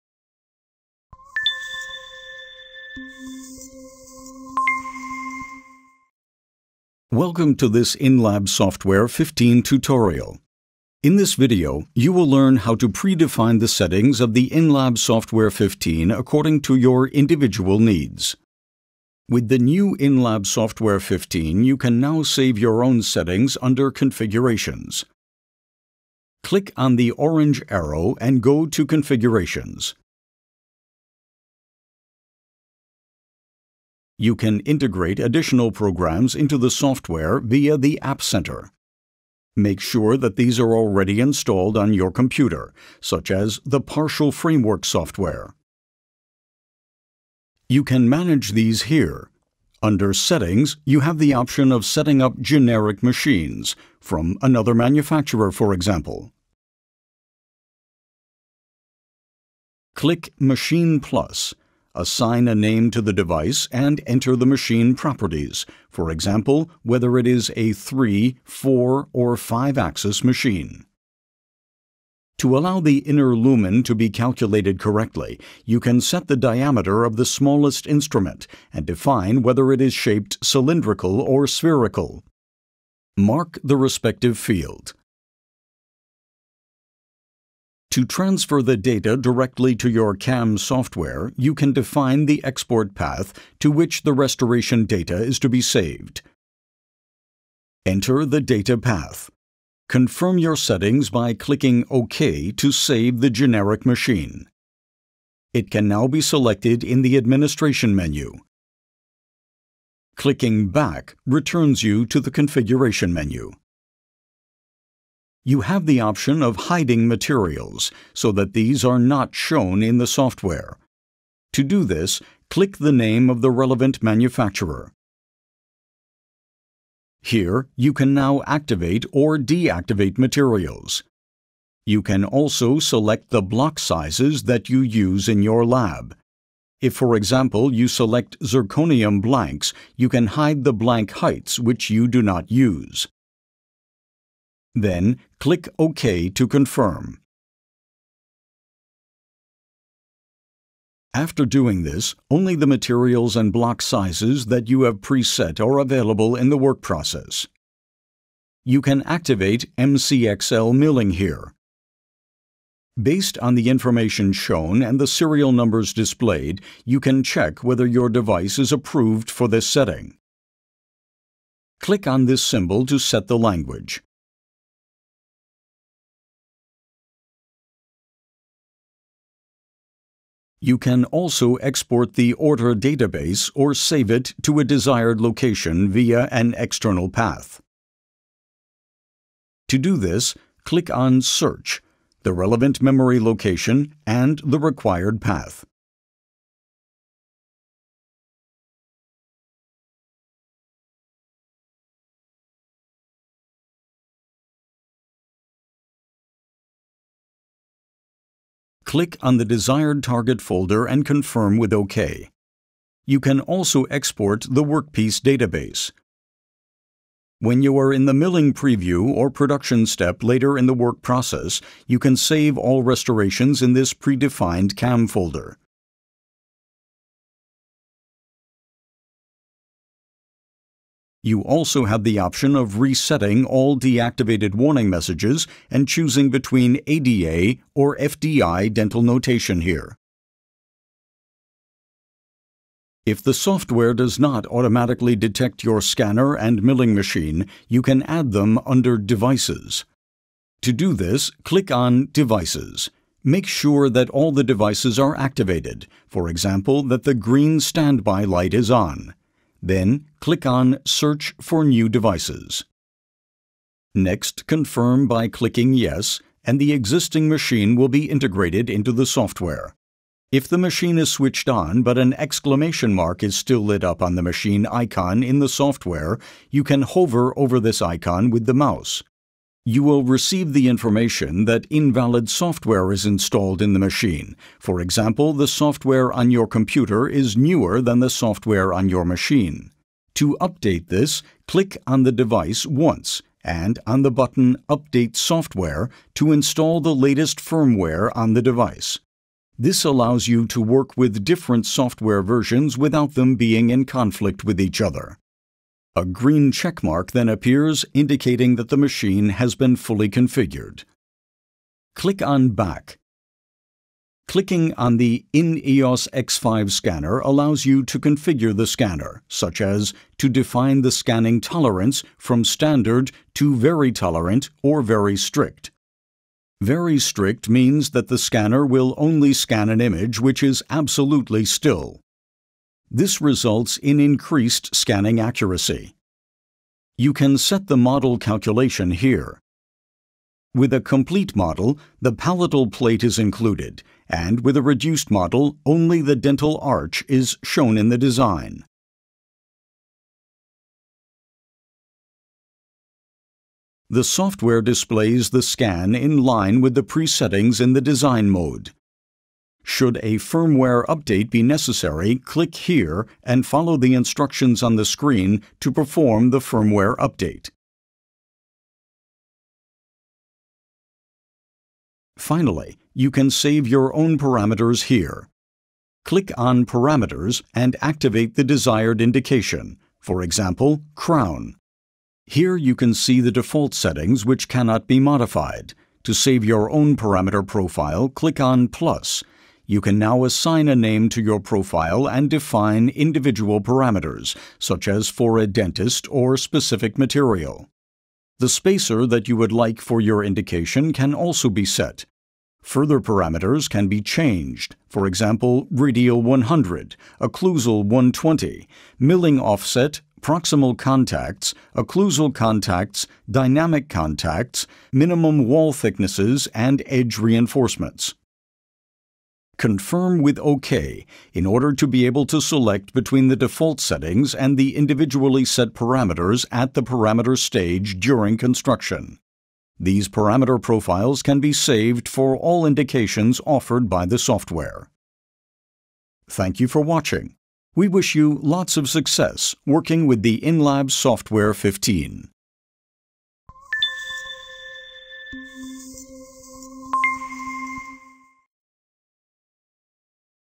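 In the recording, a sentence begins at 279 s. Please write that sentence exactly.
You will receive the information that invalid software is installed in the machine.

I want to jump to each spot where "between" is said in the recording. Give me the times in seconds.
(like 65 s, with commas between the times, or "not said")
236 s, 422 s.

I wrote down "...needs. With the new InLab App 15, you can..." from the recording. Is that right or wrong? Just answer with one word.
wrong.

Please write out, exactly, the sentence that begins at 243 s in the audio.
If the software does not automatically detect your scanner and milling machine, you can add them under Devices.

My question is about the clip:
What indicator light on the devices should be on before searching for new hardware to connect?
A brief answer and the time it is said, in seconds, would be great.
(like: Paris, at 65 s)
green standby light, at 257 s.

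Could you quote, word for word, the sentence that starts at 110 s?
Clicking Back returns you to the Configuration menu.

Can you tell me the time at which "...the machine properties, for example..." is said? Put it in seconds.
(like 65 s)
64 s.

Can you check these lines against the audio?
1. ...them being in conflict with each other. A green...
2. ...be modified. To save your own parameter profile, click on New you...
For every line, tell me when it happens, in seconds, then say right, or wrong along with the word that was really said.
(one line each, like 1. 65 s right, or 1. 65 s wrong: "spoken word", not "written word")
1. 303 s right
2. 384 s wrong: "Plus", not "New".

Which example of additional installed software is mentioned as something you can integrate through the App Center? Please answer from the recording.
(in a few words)
Partial Framework.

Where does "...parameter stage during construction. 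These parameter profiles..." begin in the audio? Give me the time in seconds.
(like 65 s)
426 s.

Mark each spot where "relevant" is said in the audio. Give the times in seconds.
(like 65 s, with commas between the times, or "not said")
123 s, 192 s.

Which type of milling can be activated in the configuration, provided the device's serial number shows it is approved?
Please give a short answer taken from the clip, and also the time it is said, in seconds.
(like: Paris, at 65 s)
MCXL milling, at 159 s.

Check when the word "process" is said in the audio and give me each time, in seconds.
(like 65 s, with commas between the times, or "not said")
156 s, 221 s.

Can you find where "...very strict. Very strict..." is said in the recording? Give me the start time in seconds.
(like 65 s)
324 s.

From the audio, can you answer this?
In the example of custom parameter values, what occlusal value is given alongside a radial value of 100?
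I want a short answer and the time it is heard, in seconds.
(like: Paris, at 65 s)
120, at 407 s.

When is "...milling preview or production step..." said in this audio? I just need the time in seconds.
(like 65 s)
218 s.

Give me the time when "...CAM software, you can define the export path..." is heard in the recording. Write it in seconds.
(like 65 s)
90 s.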